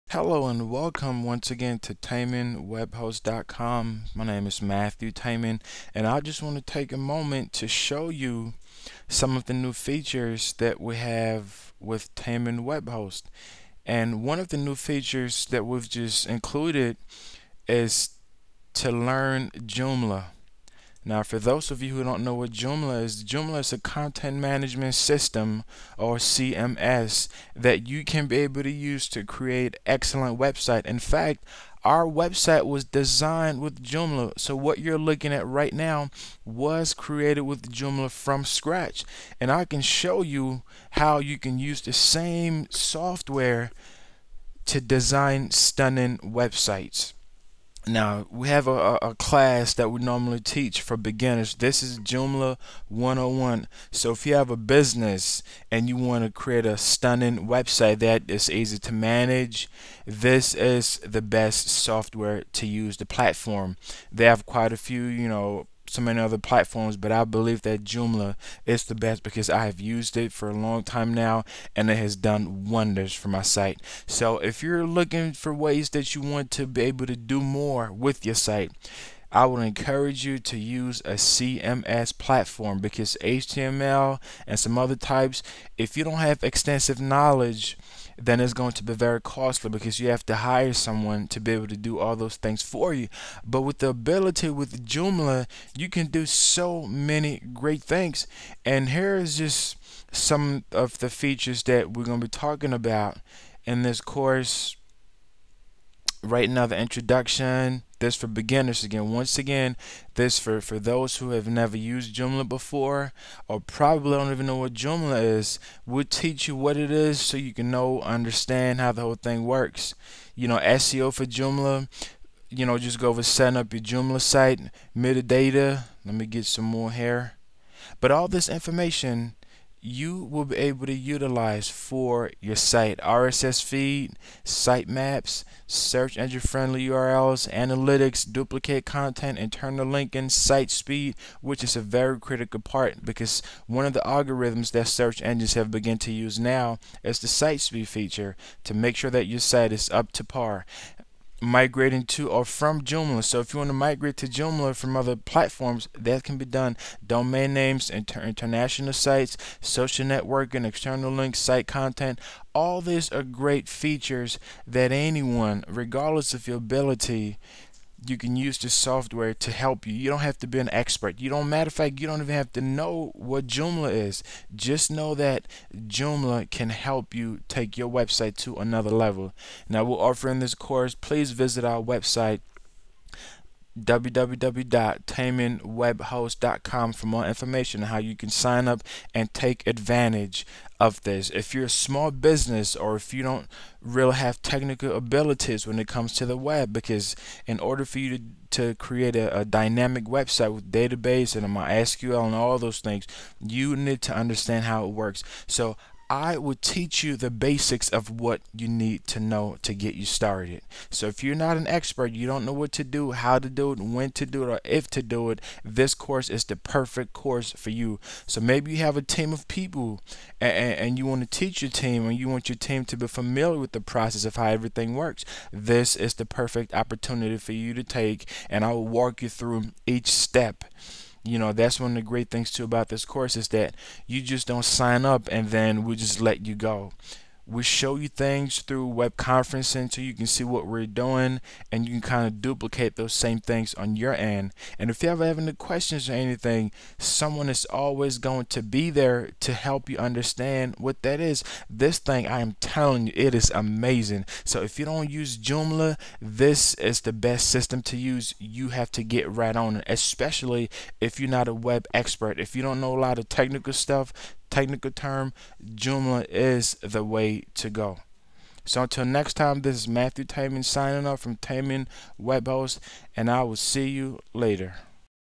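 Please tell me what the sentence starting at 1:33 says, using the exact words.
But with the ability with Joomla, you can do so many great things.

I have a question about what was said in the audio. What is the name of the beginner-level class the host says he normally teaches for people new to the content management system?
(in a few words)
Joomla 101.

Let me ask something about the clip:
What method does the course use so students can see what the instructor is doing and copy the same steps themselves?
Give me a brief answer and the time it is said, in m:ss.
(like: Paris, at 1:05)
Web conferencing, at 3:58.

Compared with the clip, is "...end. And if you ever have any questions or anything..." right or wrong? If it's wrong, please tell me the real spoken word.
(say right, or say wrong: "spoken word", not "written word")
right.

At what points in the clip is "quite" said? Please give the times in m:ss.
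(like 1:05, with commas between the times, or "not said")
1:04.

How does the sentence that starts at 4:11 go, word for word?
This thing, I am telling you, it is amazing.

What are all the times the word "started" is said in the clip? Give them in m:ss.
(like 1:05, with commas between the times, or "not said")
3:30.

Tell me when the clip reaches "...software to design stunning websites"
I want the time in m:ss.
0:42.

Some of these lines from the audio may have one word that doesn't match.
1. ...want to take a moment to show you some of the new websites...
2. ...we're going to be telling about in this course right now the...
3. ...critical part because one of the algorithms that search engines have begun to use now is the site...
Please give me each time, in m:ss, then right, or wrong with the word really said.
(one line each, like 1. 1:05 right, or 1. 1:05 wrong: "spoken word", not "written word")
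1. 0:06 wrong: "features", not "websites"
2. 1:41 wrong: "talking", not "telling"
3. 2:22 right.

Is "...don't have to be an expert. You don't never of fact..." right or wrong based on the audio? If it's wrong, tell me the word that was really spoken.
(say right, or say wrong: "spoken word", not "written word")
wrong: "matter", not "never".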